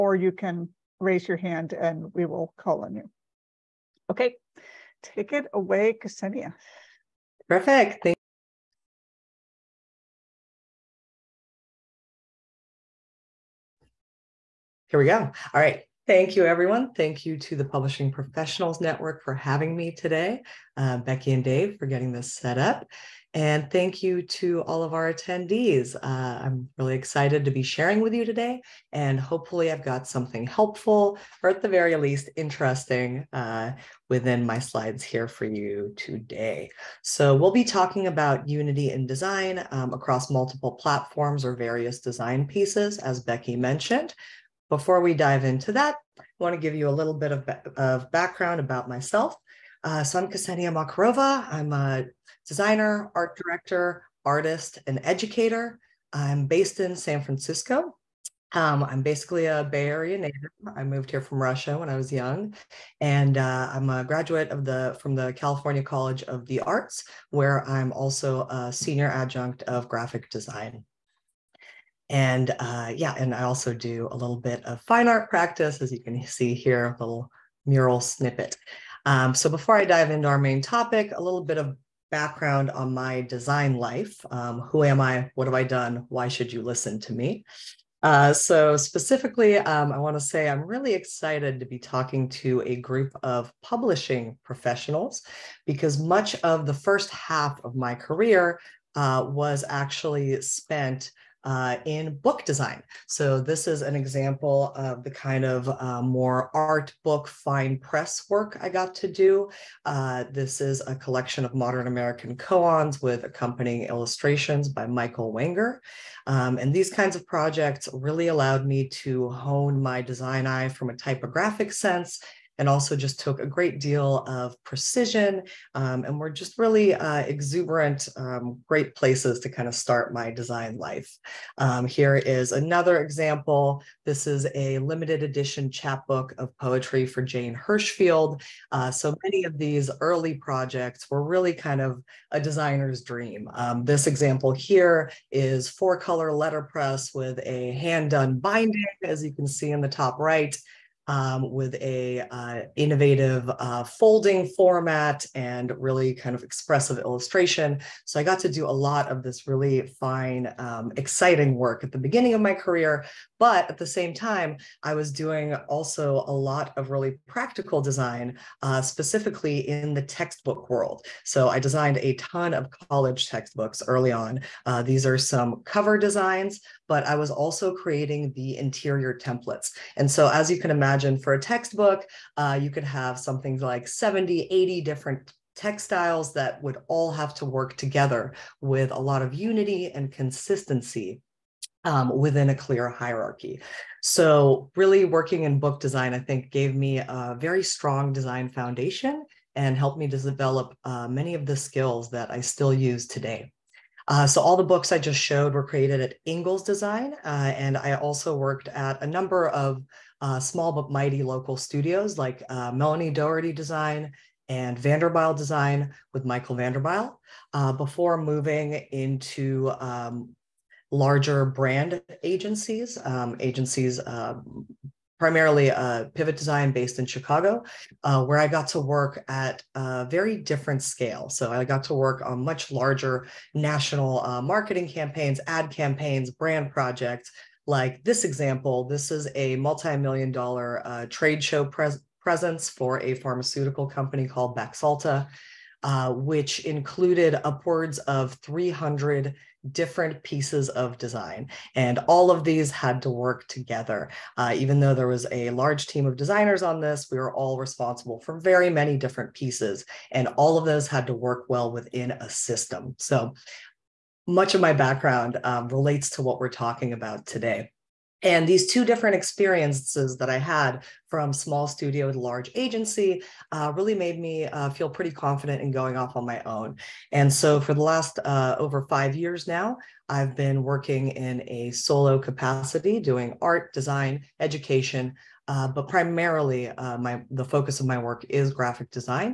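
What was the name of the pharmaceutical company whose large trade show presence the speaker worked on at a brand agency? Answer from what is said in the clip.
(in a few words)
Baxalta.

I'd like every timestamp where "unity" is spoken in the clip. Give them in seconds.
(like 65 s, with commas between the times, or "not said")
38 s, 189 s.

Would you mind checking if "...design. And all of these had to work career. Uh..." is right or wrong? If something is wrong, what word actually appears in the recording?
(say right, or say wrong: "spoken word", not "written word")
wrong: "together", not "career".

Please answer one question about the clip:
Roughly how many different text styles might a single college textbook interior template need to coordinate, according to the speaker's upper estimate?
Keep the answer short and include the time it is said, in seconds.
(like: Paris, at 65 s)
80, at 184 s.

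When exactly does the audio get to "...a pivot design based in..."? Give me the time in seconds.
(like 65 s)
225 s.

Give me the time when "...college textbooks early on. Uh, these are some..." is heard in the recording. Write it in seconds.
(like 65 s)
172 s.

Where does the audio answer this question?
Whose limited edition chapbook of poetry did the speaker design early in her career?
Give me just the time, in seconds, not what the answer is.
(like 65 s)
137 s.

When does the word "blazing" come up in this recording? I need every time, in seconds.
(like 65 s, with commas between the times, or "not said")
not said.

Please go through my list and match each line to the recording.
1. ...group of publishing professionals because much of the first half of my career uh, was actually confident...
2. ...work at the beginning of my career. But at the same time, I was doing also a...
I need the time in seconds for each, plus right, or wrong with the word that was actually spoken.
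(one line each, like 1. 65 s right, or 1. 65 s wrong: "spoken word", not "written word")
1. 92 s wrong: "spent", not "confident"
2. 161 s right.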